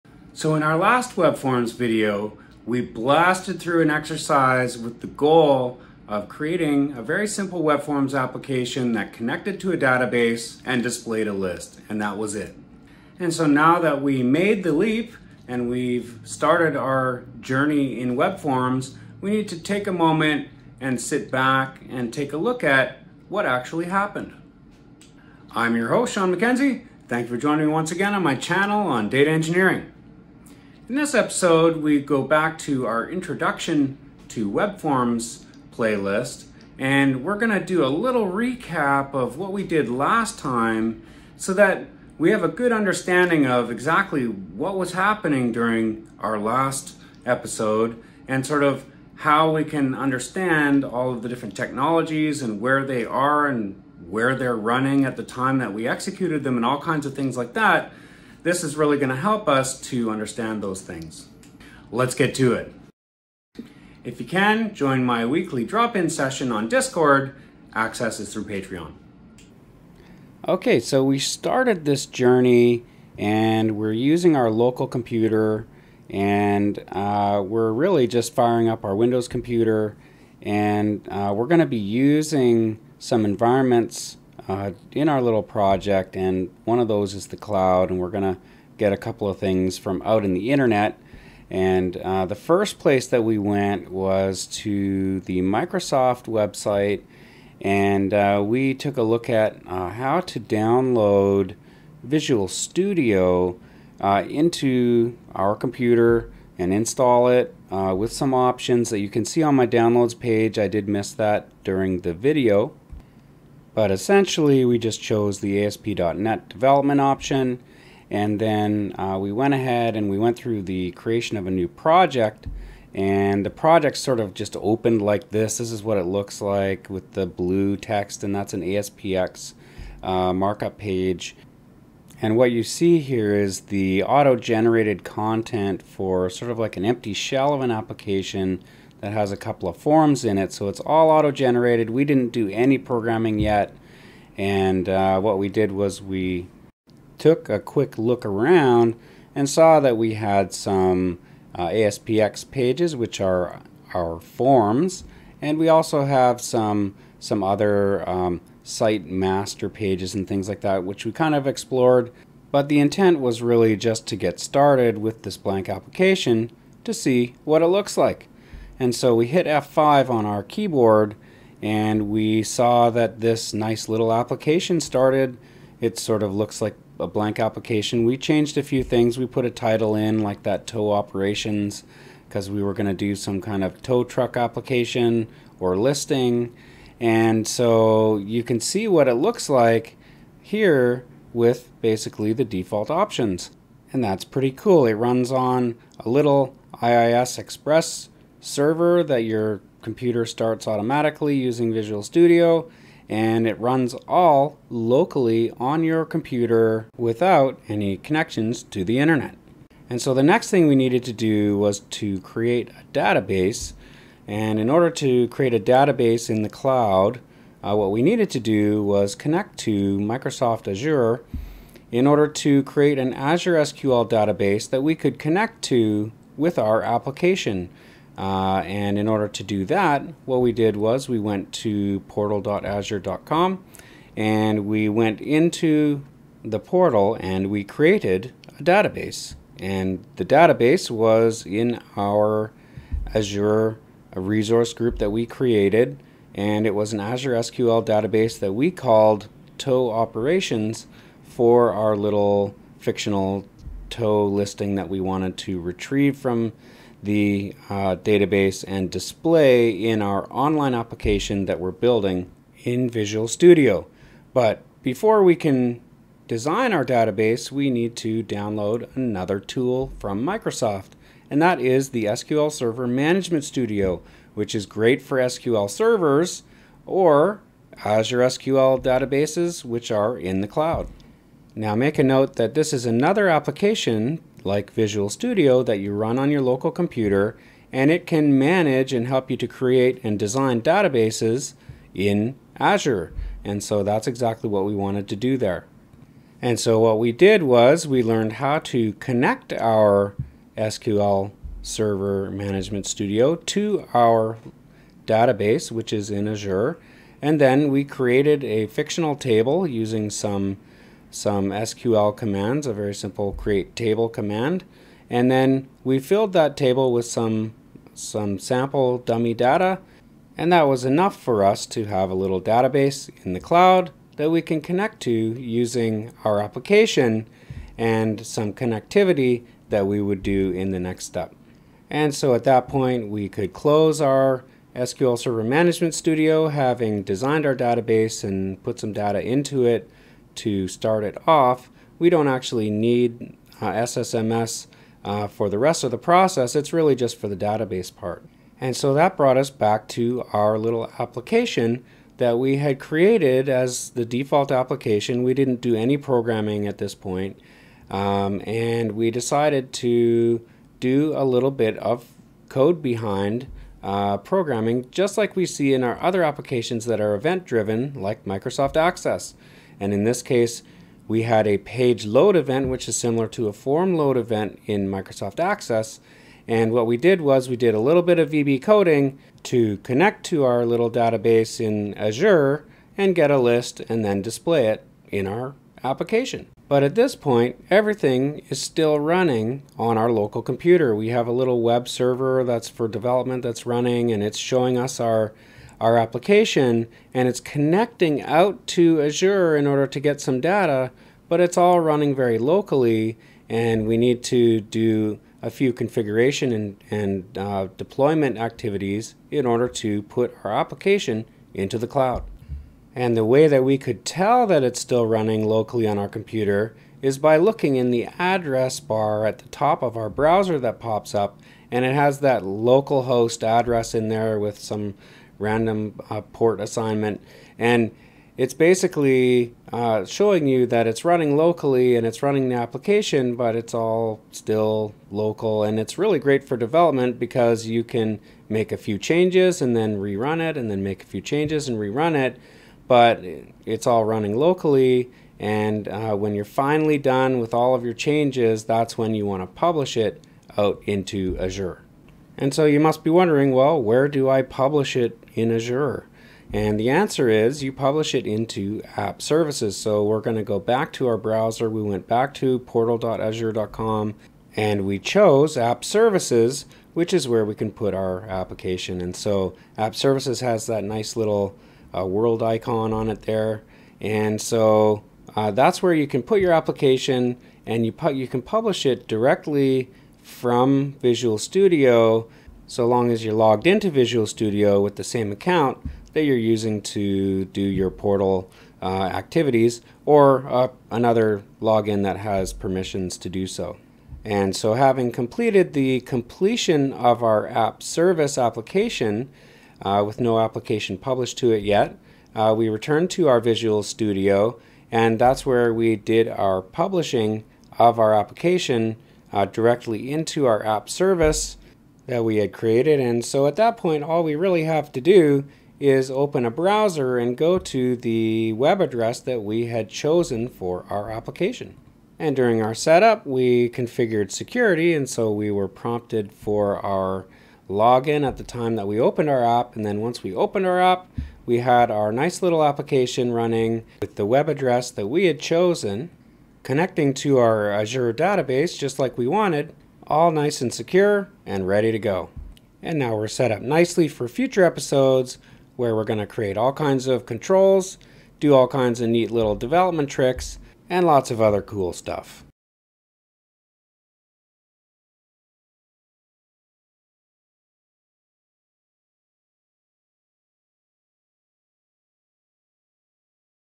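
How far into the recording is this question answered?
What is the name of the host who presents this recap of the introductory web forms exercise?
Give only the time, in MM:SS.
00:26.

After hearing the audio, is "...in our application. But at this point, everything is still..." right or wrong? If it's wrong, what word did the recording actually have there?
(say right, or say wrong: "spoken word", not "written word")
right.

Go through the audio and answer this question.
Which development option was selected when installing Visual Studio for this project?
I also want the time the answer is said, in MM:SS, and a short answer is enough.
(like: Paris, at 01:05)
ASP.NET development, at 01:55.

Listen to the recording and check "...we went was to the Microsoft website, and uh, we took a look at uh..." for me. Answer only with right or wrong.
right.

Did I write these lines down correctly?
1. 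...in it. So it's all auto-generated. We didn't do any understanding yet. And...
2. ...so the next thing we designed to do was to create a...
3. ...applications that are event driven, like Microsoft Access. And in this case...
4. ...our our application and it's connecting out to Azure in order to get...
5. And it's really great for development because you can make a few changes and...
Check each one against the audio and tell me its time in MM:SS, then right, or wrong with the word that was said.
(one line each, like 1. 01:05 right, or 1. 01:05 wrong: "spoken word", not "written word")
1. 02:20 wrong: "programming", not "understanding"
2. 03:30 wrong: "needed", not "designed"
3. 06:06 right
4. 06:34 right
5. 07:15 right.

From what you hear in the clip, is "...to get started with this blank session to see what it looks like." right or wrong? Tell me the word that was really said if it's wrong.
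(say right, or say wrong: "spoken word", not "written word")
wrong: "application", not "session".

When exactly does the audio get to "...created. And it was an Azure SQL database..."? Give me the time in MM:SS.
04:05.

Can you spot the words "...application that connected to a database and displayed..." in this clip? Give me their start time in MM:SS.
00:08.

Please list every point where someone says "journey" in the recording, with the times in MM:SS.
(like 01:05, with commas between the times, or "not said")
00:17, 01:12.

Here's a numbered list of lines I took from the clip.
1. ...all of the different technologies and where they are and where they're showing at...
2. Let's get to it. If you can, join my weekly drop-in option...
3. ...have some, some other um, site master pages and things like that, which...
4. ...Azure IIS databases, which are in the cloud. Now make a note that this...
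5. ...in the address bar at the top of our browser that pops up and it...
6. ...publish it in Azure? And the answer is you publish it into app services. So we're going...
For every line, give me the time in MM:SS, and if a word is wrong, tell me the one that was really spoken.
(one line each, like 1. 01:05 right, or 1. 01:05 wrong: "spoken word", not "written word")
1. 00:50 wrong: "running", not "showing"
2. 01:01 wrong: "session", not "option"
3. 02:36 right
4. 04:37 wrong: "SQL", not "IIS"
5. 06:57 right
6. 07:34 right.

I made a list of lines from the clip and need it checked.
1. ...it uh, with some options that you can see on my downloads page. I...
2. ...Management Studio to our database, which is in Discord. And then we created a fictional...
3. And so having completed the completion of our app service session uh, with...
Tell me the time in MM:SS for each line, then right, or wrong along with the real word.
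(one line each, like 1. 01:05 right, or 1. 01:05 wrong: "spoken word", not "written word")
1. 01:47 right
2. 05:02 wrong: "Azure", not "Discord"
3. 08:14 wrong: "application", not "session".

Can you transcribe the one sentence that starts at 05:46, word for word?
It's really just for the database part.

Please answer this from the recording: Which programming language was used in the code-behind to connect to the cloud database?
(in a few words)
VB.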